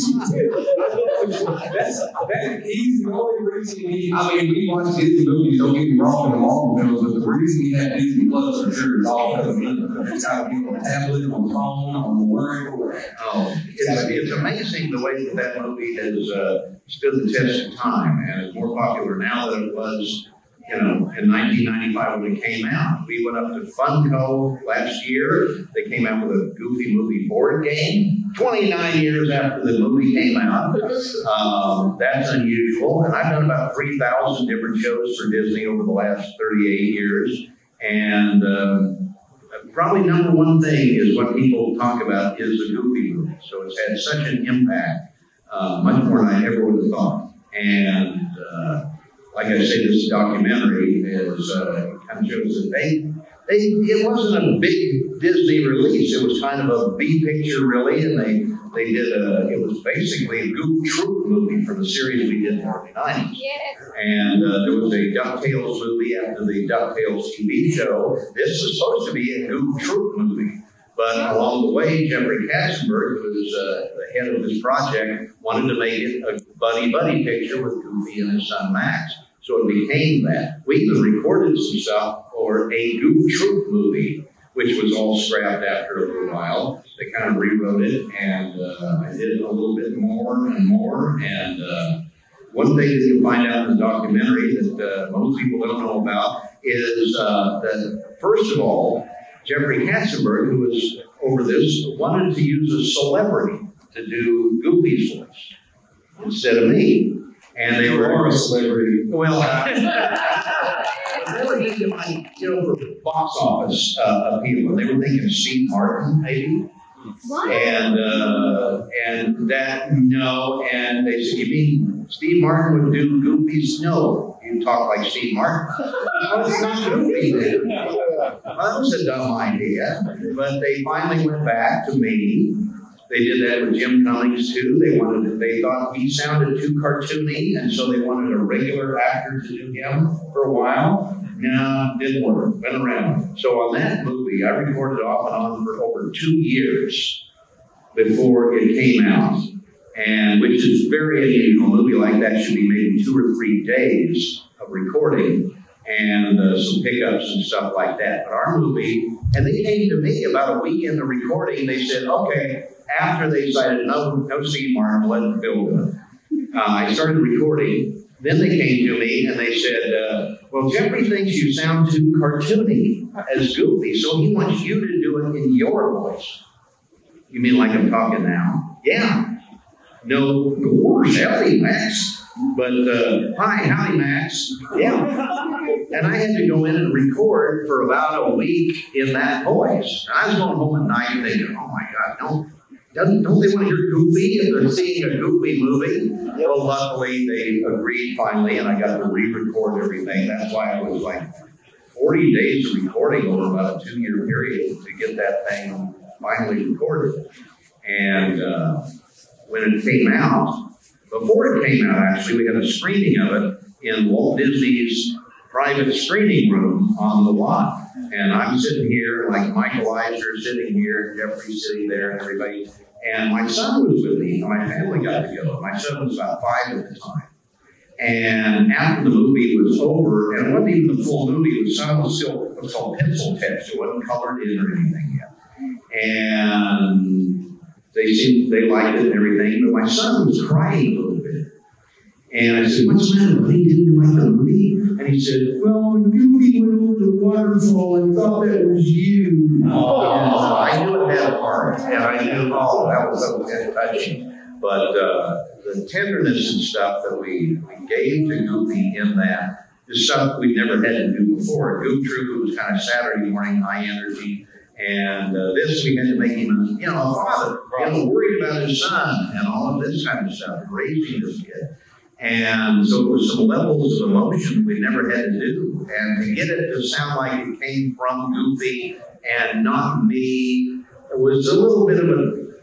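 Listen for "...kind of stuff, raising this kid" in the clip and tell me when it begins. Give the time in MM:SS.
04:30.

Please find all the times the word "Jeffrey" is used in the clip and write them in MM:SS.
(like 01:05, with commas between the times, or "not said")
01:12, 01:39, 02:50, 03:41.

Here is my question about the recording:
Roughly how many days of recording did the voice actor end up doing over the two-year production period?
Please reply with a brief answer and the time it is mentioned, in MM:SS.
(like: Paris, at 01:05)
40, at 03:21.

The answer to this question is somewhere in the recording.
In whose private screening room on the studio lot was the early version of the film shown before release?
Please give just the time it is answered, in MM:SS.
03:34.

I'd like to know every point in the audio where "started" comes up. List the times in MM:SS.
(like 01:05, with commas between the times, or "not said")
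02:46.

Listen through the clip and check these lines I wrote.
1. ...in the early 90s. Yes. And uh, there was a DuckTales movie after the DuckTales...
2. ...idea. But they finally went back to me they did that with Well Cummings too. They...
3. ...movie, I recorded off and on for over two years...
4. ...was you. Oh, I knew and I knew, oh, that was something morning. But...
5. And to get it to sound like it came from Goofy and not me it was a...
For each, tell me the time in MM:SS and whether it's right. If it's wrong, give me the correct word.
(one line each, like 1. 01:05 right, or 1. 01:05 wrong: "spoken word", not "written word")
1. 01:02 right
2. 02:09 wrong: "Jim", not "Well"
3. 02:24 right
4. 04:08 wrong: "touching", not "morning"
5. 04:35 right.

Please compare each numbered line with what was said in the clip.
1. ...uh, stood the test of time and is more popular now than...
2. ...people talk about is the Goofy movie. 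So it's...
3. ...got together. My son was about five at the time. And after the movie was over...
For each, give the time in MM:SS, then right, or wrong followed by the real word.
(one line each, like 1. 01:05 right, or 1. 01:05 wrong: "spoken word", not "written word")
1. 00:16 right
2. 00:41 right
3. 03:45 right.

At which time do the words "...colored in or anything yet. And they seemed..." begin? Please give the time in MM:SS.
03:54.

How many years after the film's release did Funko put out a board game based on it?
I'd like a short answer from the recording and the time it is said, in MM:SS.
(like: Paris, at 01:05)
29, at 00:28.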